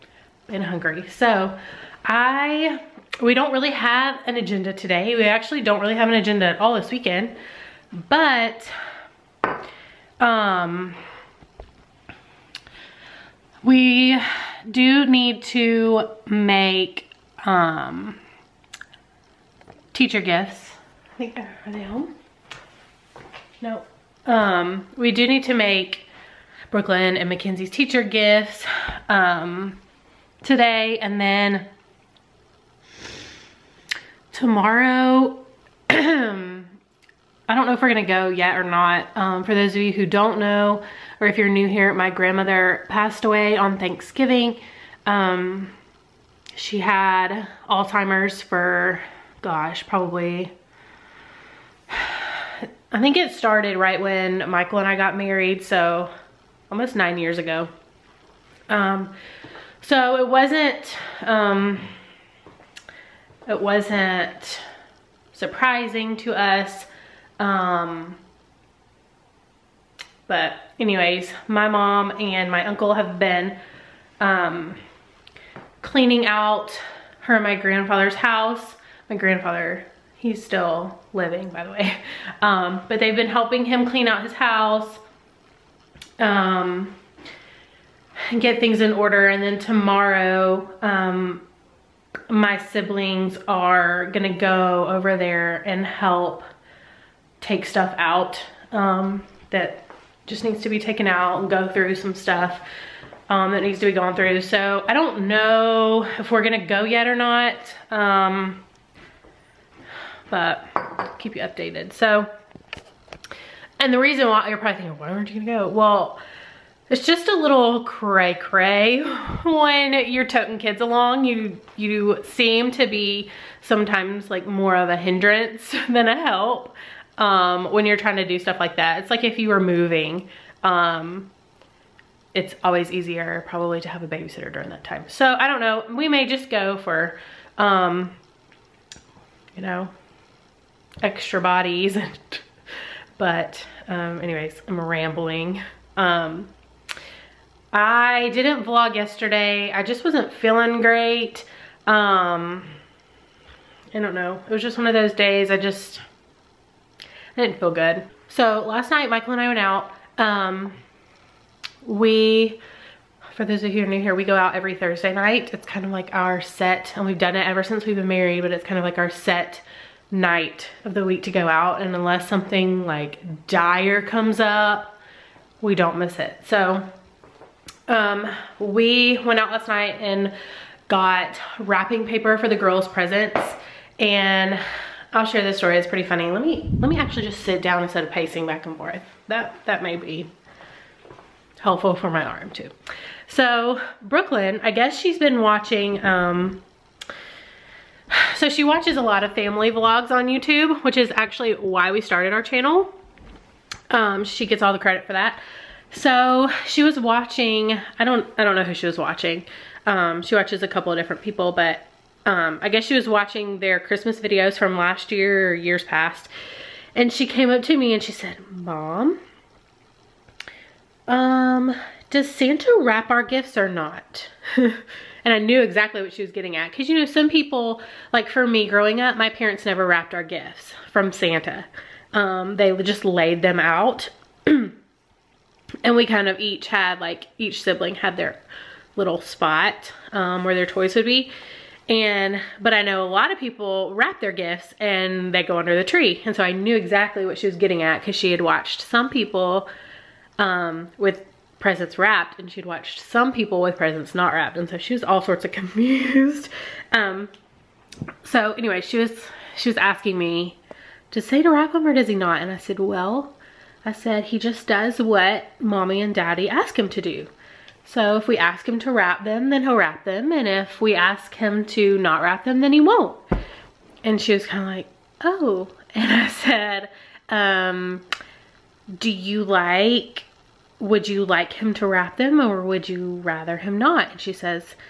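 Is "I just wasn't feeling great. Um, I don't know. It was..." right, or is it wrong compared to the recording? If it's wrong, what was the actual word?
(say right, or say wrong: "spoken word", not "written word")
right.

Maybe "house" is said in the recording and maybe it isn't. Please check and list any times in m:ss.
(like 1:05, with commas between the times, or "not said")
1:18, 1:24.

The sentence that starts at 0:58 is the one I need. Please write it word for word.
Um, so it wasn't, um, it wasn't surprising to us.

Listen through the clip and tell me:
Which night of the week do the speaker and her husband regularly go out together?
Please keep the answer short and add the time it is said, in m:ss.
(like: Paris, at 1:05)
Thursday, at 2:44.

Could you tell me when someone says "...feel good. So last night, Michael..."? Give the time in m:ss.
2:37.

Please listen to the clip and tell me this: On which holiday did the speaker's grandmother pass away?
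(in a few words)
Thanksgiving.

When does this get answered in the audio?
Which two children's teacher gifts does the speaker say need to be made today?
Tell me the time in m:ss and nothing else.
0:26.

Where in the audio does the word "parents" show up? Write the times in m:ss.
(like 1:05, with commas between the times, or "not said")
3:49.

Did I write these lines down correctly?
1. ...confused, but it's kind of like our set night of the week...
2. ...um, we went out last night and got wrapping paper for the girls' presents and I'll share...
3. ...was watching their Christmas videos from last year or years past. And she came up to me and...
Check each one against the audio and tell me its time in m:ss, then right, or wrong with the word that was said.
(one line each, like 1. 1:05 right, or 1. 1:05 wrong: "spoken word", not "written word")
1. 2:48 wrong: "married", not "confused"
2. 2:57 right
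3. 3:32 right.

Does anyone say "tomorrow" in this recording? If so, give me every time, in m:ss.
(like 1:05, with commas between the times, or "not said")
0:34, 1:29.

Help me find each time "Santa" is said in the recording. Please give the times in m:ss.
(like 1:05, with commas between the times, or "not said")
3:42, 3:51.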